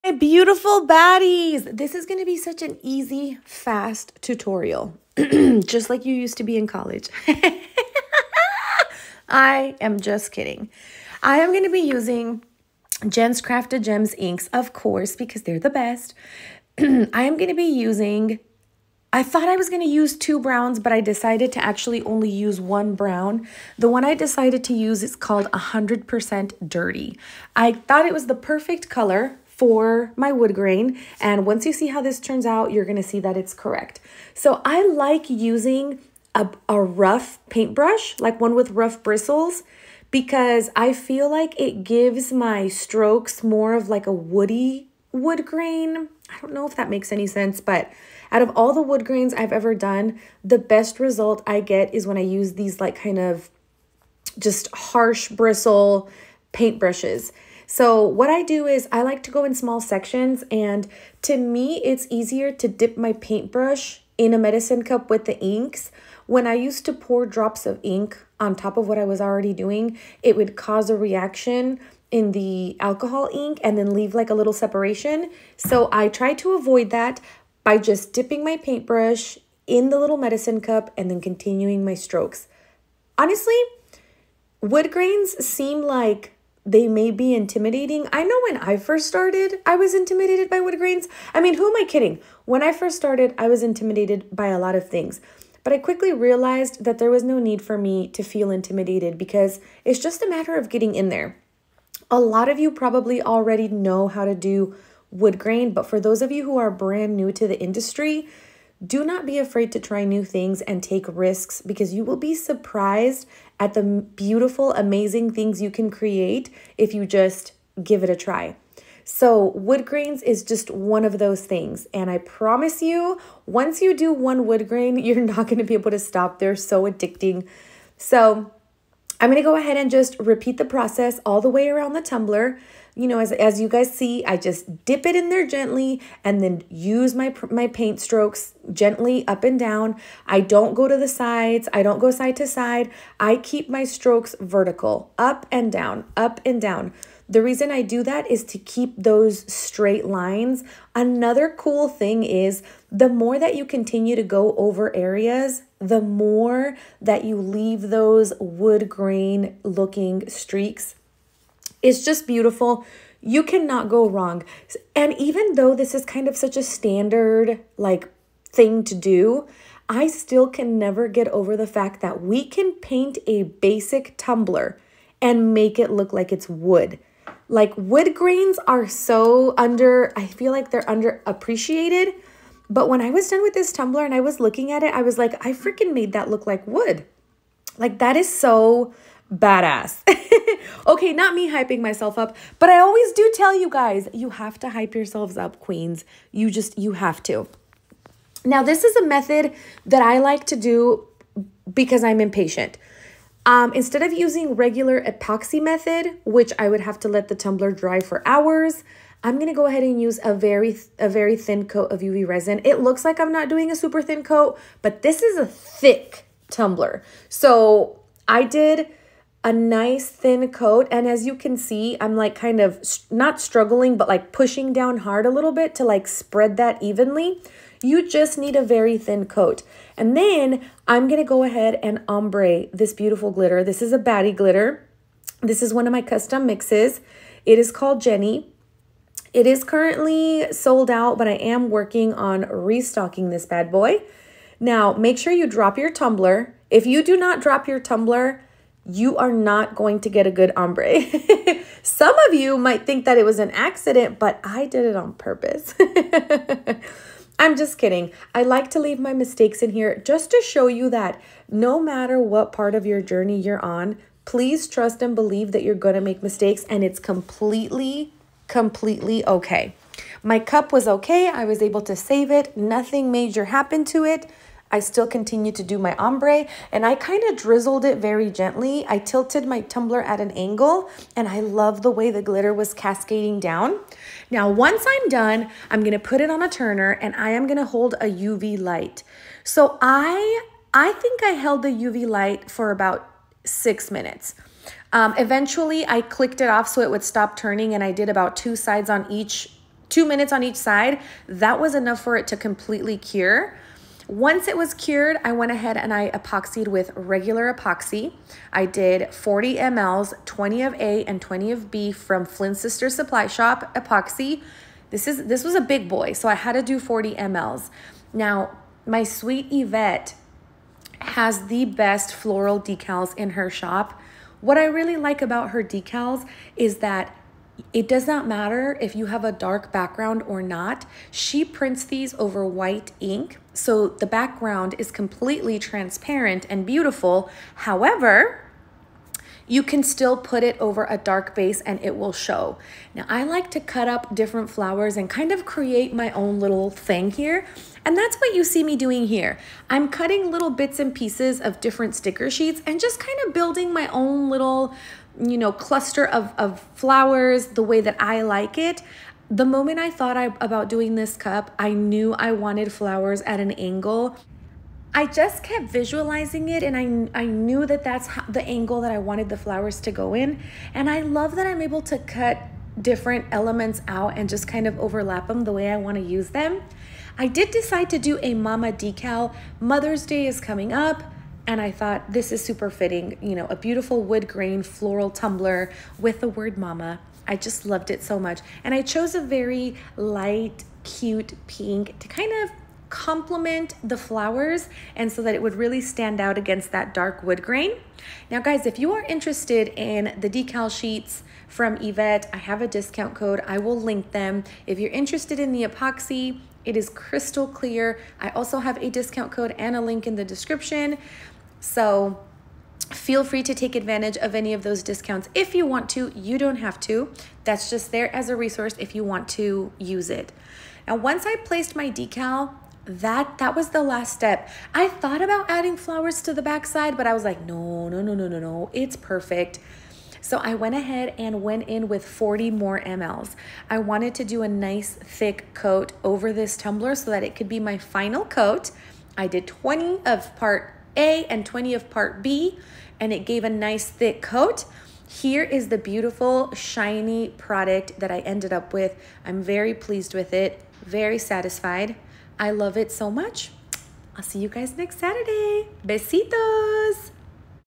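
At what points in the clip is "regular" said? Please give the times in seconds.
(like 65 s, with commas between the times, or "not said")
204 s, 306 s.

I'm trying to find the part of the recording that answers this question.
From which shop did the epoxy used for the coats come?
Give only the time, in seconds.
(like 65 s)
312 s.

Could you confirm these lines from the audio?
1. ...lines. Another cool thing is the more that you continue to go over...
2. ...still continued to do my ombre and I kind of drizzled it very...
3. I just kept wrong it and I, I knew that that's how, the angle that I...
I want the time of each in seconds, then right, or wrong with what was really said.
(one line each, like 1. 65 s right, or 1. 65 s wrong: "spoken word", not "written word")
1. 150 s right
2. 274 s right
3. 364 s wrong: "visualizing", not "wrong".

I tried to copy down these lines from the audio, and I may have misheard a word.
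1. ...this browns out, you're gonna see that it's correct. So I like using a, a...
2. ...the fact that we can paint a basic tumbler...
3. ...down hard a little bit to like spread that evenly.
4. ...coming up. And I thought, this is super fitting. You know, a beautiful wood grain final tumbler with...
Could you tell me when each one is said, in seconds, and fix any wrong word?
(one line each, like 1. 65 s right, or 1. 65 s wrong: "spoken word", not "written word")
1. 32 s wrong: "turns", not "browns"
2. 171 s right
3. 224 s right
4. 380 s wrong: "floral", not "final".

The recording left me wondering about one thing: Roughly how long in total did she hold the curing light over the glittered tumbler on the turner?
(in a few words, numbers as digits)
6 minutes.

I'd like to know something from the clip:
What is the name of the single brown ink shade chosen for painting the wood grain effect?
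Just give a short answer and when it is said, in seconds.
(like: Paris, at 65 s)
100% Dirty, at 25 s.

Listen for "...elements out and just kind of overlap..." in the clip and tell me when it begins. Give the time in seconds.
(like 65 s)
373 s.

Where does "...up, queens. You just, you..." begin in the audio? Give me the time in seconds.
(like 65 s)
195 s.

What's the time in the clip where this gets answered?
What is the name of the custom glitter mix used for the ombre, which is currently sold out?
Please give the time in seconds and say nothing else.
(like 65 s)
237 s.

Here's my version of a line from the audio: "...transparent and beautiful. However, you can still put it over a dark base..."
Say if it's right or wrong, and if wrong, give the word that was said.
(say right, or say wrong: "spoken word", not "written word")
right.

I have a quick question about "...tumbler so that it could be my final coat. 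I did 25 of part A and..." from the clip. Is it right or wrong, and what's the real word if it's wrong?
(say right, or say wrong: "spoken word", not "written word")
wrong: "20", not "25".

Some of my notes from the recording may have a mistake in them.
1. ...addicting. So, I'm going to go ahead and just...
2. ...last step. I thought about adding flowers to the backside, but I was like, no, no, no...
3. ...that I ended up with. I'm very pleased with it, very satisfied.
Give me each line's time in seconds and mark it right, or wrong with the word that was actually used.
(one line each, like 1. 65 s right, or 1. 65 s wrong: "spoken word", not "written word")
1. 126 s right
2. 423 s right
3. 447 s right.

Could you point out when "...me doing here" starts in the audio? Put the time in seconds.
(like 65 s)
348 s.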